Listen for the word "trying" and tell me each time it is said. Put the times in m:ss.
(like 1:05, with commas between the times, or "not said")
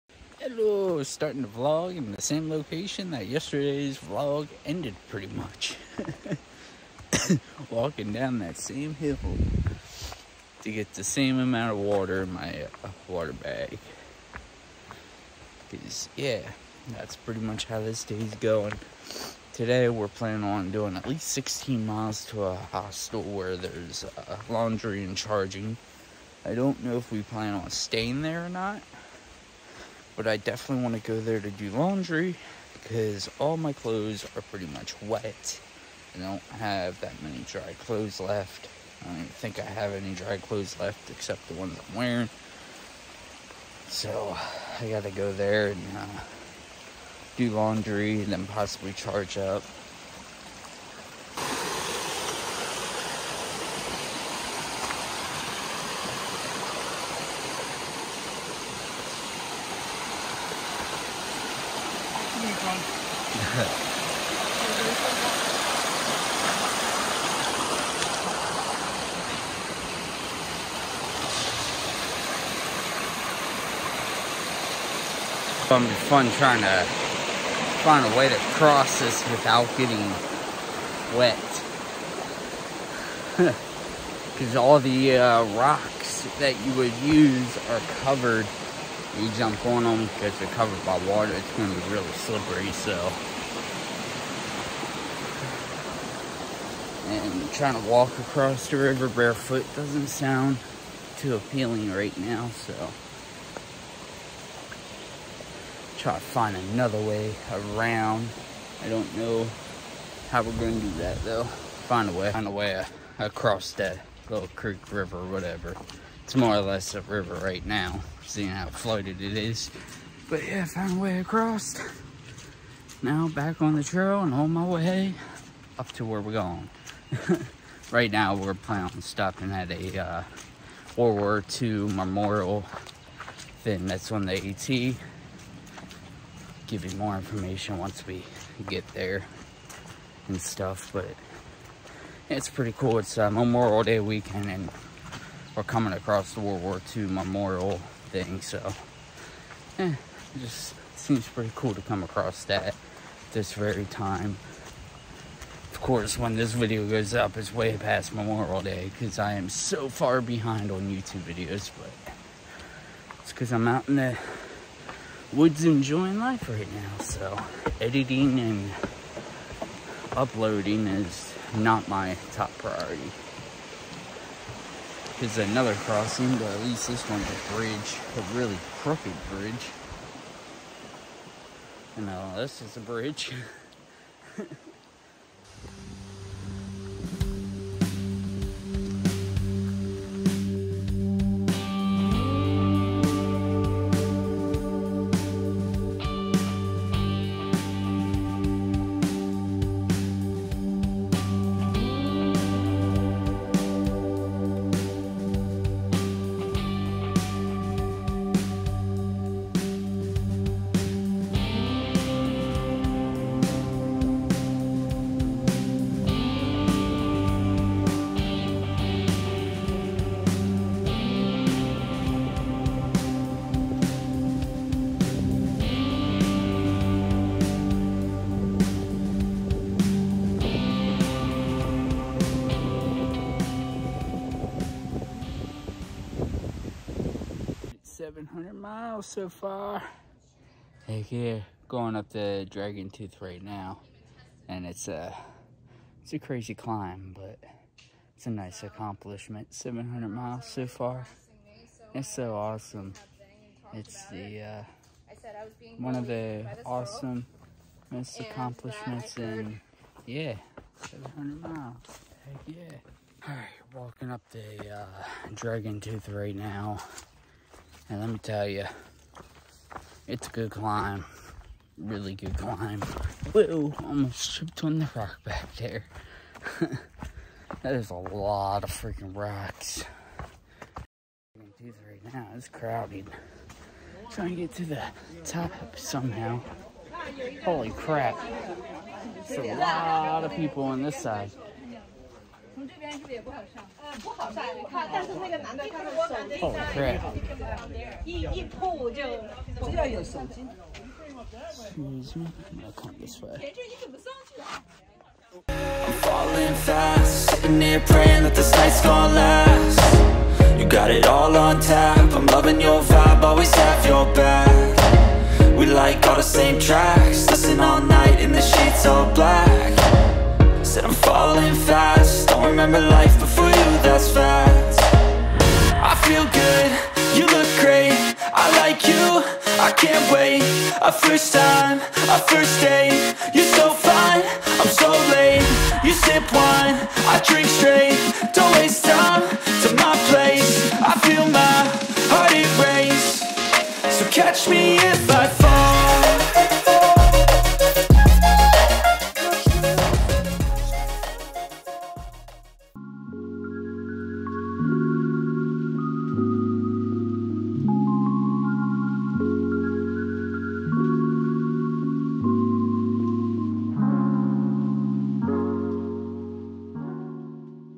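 1:16, 1:37, 4:44.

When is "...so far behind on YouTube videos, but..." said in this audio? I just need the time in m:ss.
2:39.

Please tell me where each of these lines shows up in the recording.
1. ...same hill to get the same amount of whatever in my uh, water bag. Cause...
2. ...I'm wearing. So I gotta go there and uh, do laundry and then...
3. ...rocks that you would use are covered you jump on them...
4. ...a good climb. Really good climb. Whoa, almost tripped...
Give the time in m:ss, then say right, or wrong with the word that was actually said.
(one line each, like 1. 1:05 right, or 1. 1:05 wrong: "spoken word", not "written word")
1. 0:08 wrong: "water", not "whatever"
2. 0:41 right
3. 1:25 right
4. 4:30 right.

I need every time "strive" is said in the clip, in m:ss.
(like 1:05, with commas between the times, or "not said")
not said.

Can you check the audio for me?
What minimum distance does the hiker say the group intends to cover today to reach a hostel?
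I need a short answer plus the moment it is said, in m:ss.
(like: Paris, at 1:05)
16 miles, at 0:21.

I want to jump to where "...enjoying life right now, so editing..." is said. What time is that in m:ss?
2:45.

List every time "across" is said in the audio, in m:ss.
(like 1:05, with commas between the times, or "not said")
1:38, 1:53, 2:01, 2:25, 2:32.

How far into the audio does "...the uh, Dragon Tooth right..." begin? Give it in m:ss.
4:24.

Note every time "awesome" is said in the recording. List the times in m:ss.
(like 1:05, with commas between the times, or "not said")
4:12, 4:16.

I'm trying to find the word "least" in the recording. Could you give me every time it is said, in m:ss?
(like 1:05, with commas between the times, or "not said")
0:21, 2:56.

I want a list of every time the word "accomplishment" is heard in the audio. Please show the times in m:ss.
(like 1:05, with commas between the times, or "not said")
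4:08, 4:18.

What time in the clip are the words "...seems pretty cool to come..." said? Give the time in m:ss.
2:30.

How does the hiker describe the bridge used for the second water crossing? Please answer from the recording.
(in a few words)
really crooked.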